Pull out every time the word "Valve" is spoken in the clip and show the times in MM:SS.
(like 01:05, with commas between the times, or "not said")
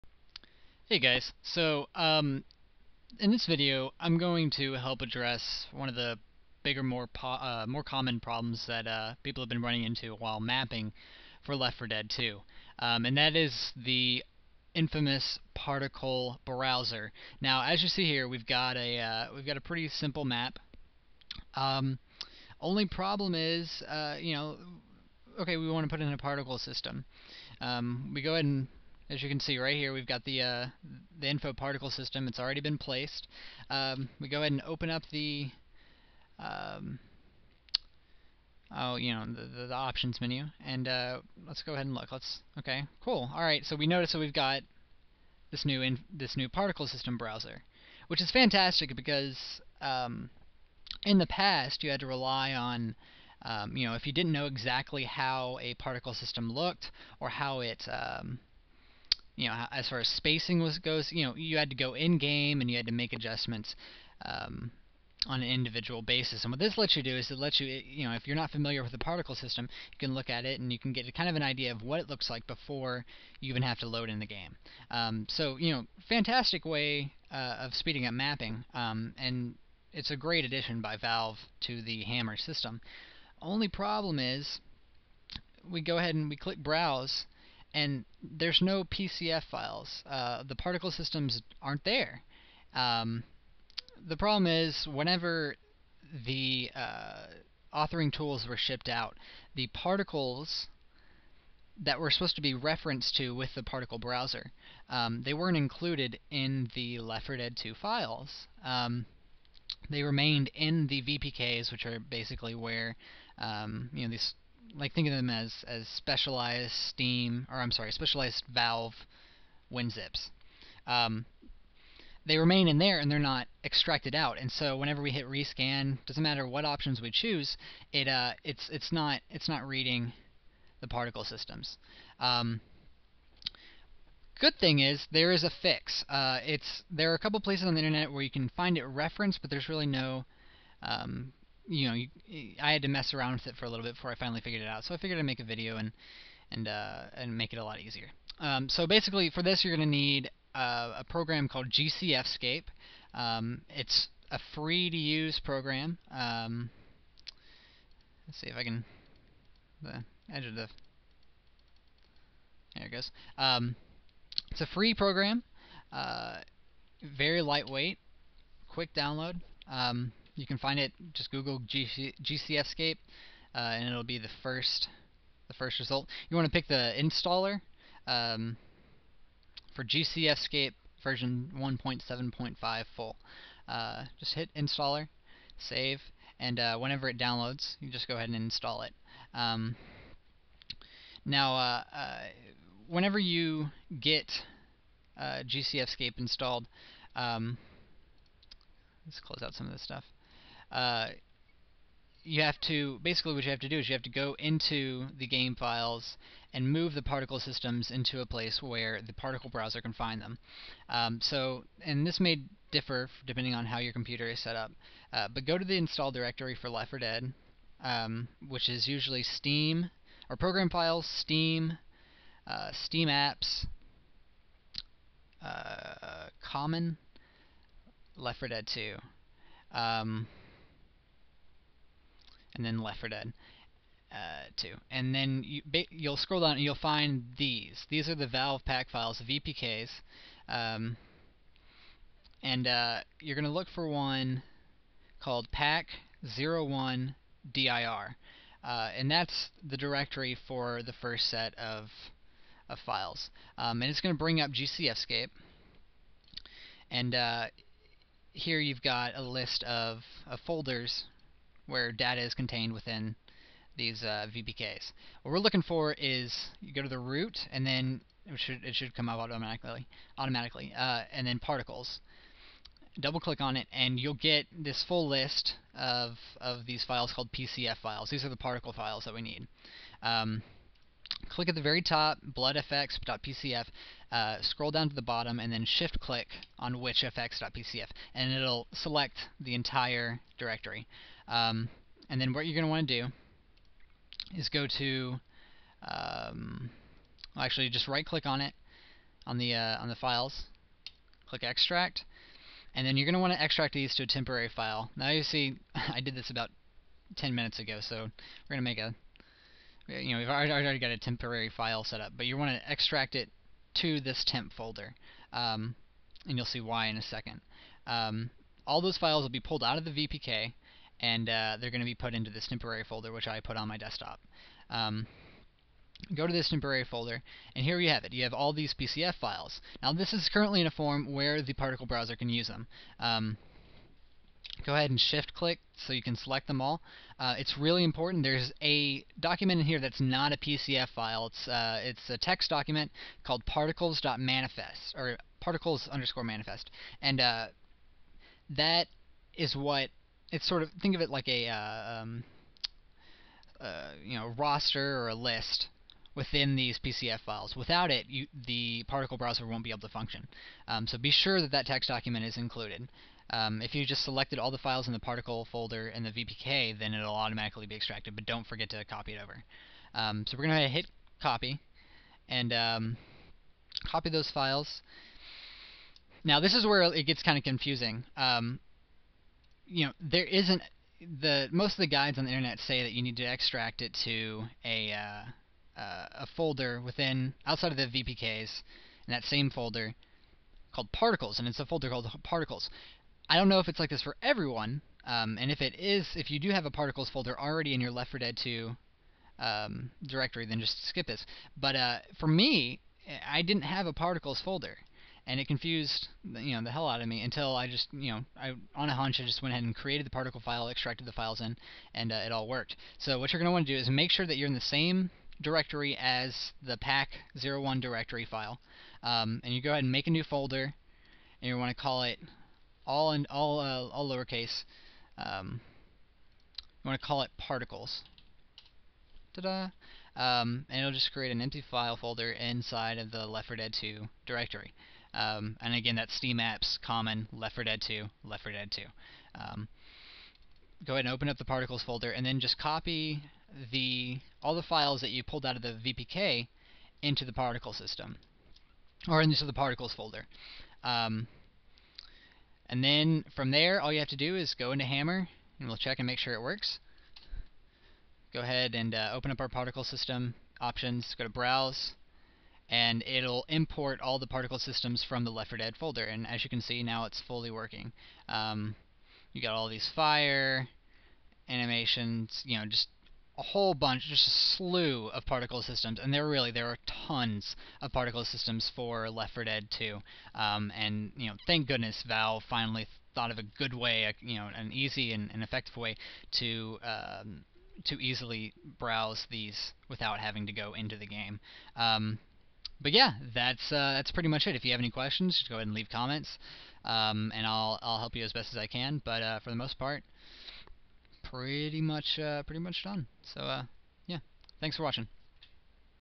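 01:20, 01:58, 03:58, 08:02.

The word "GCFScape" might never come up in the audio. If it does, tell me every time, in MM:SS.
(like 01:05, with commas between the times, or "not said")
02:31, 02:52, 02:59, 03:15, 04:14.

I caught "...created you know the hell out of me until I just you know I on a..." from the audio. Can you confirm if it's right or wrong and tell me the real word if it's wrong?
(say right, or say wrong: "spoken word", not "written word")
wrong: "confused", not "created".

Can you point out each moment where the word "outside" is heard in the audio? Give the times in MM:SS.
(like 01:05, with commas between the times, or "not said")
06:27.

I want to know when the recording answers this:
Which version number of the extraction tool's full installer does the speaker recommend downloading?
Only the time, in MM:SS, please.
03:01.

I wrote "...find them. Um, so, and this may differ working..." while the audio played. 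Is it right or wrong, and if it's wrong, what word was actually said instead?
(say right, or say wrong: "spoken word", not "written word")
wrong: "depending", not "working".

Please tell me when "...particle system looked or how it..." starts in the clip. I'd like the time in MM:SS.
00:55.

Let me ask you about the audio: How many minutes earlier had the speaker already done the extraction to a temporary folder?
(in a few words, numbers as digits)
10.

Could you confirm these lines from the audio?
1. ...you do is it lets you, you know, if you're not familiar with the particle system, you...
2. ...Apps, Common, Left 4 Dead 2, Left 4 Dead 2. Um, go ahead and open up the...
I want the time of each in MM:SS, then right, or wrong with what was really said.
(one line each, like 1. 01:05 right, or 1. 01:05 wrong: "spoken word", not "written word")
1. 01:06 right
2. 07:16 right.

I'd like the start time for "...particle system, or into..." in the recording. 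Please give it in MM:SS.
07:27.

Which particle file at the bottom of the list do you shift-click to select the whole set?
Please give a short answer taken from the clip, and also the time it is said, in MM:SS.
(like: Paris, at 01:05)
witchfx.pcf, at 04:46.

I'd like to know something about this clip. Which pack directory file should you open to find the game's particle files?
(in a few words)
pack 01 dir.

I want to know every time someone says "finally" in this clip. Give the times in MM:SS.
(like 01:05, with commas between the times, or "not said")
02:24, 08:02.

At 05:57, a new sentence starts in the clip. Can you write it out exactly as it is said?
Without it, you, the particle browser won't be able to function.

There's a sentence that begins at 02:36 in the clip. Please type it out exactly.
Um, let's see if I can the edge of the there it goes.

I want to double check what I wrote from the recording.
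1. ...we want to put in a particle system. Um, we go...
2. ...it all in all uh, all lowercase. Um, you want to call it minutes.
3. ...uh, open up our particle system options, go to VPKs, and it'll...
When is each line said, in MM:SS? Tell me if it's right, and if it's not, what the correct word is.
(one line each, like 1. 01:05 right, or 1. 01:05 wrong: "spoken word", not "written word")
1. 00:25 right
2. 07:02 wrong: "particles", not "minutes"
3. 07:38 wrong: "Browse", not "VPKs".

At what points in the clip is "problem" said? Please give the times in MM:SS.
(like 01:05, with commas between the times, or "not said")
00:08, 00:22, 01:23, 01:34.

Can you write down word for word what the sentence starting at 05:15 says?
Um, and you'll see why in a second.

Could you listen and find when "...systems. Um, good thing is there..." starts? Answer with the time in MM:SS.
02:11.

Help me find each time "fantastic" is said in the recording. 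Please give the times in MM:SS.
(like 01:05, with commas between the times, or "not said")
00:48, 01:16.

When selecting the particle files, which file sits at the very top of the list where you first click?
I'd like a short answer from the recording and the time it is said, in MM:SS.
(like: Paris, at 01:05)
bloodfx.pcf, at 04:42.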